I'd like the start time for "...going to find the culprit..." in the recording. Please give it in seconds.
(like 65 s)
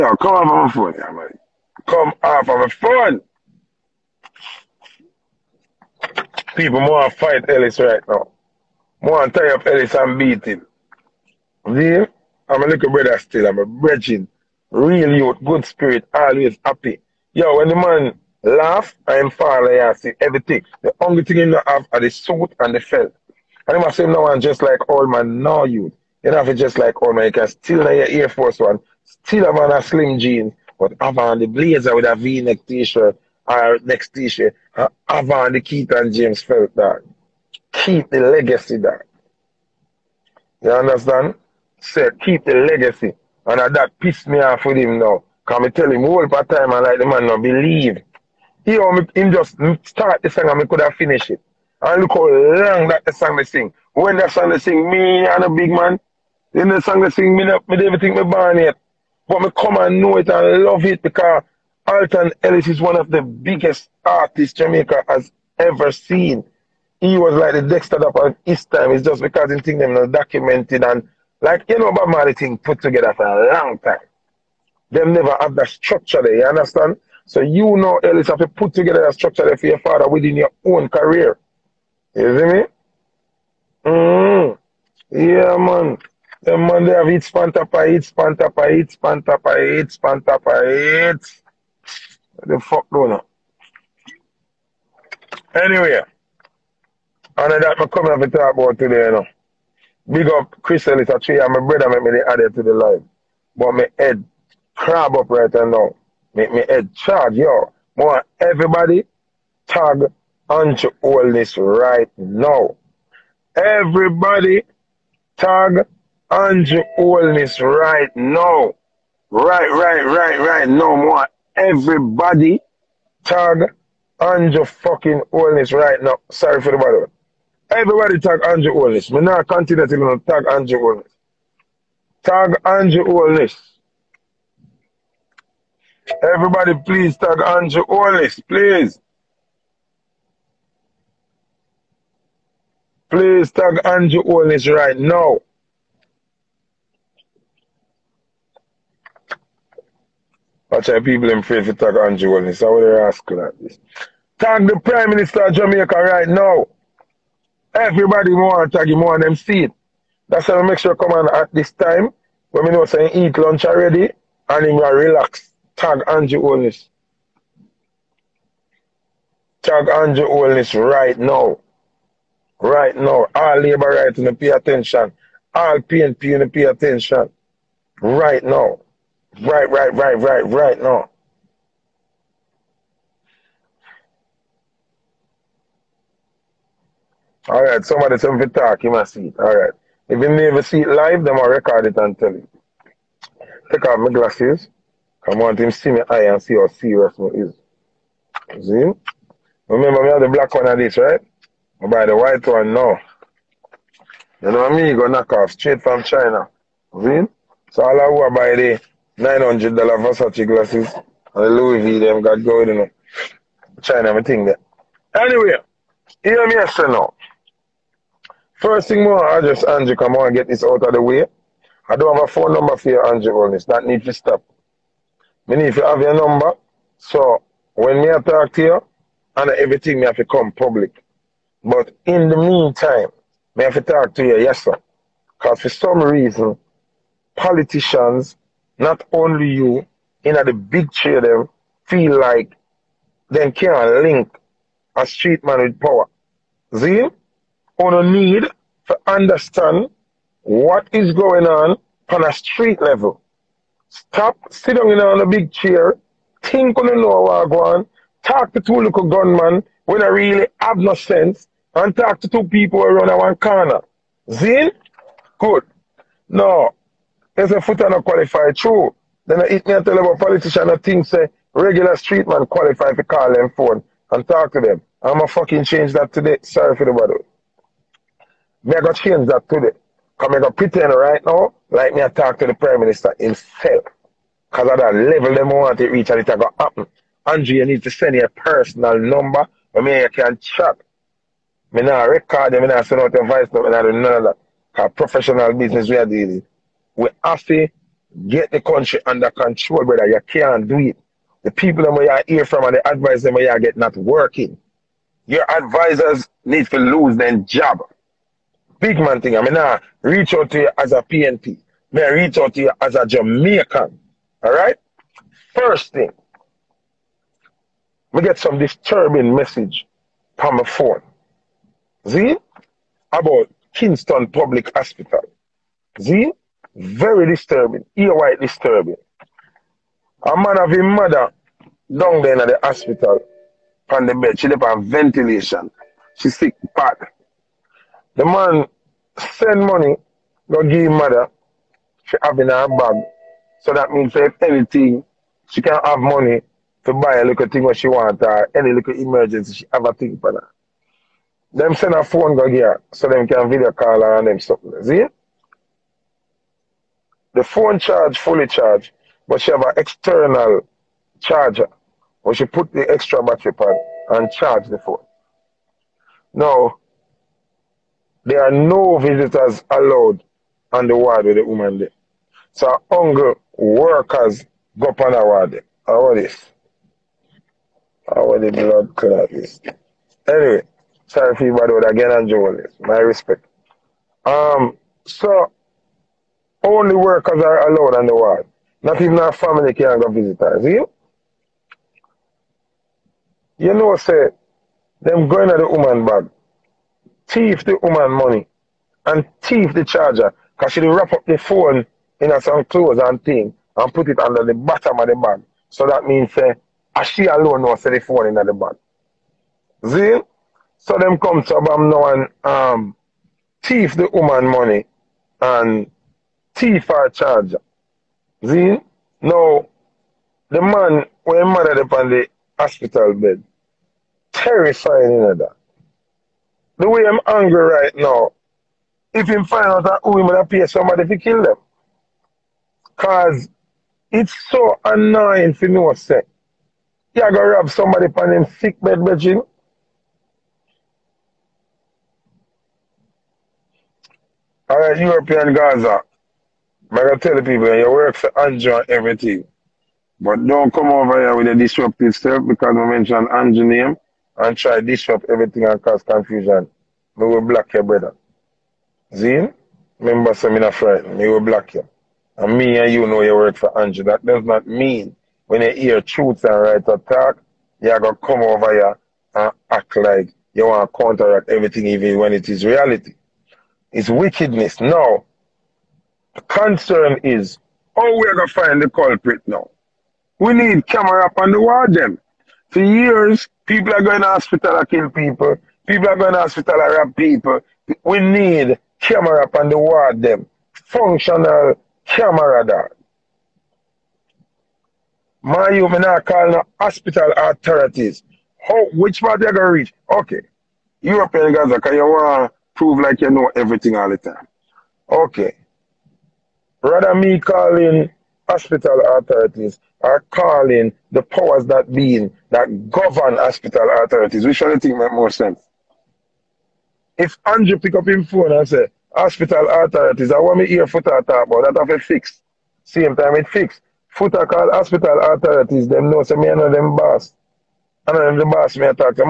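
478 s.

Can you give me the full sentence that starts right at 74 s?
Them never have that structure there, you understand?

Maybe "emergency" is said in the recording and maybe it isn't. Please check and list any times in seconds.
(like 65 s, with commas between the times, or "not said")
348 s.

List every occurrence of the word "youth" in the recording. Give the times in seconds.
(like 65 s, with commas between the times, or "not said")
15 s, 25 s.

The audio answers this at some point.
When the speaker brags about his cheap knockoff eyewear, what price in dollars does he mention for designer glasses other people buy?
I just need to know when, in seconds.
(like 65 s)
209 s.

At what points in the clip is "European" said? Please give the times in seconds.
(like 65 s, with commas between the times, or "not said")
444 s, 501 s.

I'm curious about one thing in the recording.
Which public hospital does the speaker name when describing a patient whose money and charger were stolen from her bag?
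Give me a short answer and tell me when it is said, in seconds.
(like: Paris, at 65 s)
Kingston Public Hospital, at 323 s.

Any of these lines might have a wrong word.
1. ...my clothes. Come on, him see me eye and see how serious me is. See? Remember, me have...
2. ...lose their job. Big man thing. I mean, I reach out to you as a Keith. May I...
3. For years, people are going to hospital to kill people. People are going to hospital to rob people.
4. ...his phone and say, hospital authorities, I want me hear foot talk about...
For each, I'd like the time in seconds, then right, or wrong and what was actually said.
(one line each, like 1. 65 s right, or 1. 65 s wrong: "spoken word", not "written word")
1. 193 s wrong: "glasses", not "clothes"
2. 306 s wrong: "PNP", not "Keith"
3. 482 s right
4. 518 s right.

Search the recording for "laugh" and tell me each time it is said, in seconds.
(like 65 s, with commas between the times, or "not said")
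18 s.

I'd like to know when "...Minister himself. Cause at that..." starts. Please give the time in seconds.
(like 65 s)
282 s.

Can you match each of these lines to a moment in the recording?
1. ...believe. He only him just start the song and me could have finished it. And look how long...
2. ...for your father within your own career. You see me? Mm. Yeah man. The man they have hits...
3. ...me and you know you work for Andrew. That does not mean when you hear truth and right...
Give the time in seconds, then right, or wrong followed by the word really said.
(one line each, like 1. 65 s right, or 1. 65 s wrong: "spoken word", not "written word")
1. 47 s right
2. 79 s right
3. 462 s right.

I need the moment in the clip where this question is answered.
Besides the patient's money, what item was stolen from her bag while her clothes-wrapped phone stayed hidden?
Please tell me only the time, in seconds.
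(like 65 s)
399 s.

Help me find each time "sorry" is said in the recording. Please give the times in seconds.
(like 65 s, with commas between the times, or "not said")
126 s, 276 s, 381 s.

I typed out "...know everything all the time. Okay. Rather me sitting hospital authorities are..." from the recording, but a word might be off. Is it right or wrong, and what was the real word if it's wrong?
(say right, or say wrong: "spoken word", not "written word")
wrong: "calling", not "sitting".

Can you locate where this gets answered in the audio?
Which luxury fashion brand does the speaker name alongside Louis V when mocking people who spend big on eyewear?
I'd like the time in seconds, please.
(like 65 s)
209 s.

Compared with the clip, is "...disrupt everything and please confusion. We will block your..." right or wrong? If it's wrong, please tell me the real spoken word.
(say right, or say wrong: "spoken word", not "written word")
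wrong: "cause", not "please".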